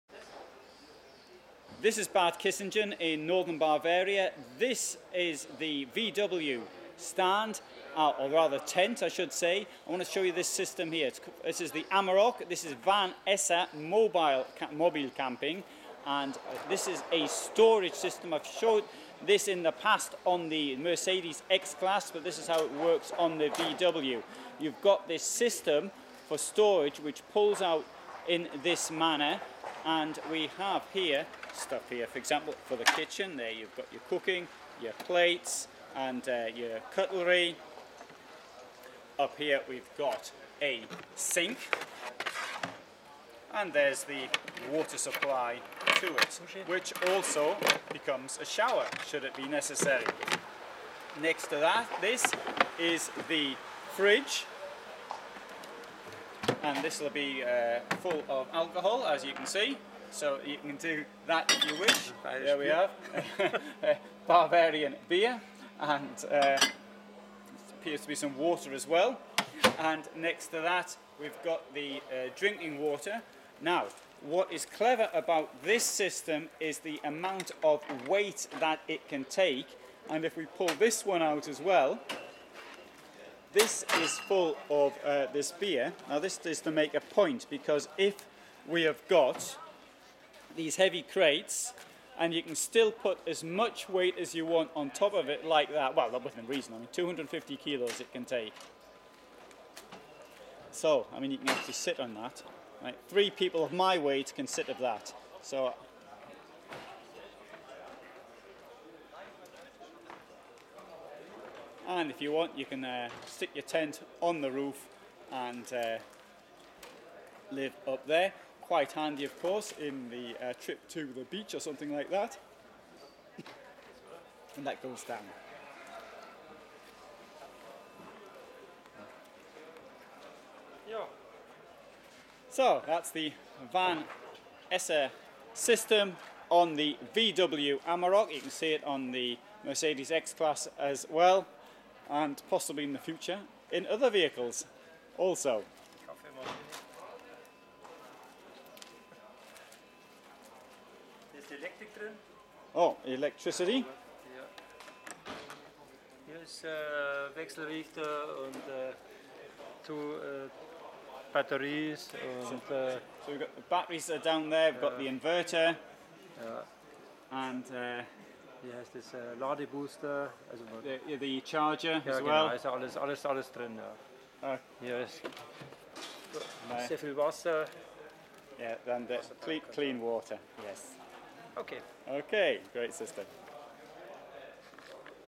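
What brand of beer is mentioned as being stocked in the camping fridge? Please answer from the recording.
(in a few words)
Barbarian.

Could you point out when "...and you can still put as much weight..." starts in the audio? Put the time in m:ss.
1:32.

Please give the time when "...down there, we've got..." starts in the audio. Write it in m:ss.
2:44.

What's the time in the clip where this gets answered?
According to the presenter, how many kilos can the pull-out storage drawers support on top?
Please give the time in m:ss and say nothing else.
1:36.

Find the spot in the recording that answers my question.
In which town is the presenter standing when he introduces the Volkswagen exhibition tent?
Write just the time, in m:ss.
0:02.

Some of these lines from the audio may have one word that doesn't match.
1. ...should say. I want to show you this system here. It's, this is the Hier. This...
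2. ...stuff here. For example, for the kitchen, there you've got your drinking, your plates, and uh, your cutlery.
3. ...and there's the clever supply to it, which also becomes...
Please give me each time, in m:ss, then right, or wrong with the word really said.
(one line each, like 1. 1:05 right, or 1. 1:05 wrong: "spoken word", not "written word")
1. 0:09 wrong: "Amarok", not "Hier"
2. 0:31 wrong: "cooking", not "drinking"
3. 0:43 wrong: "water", not "clever".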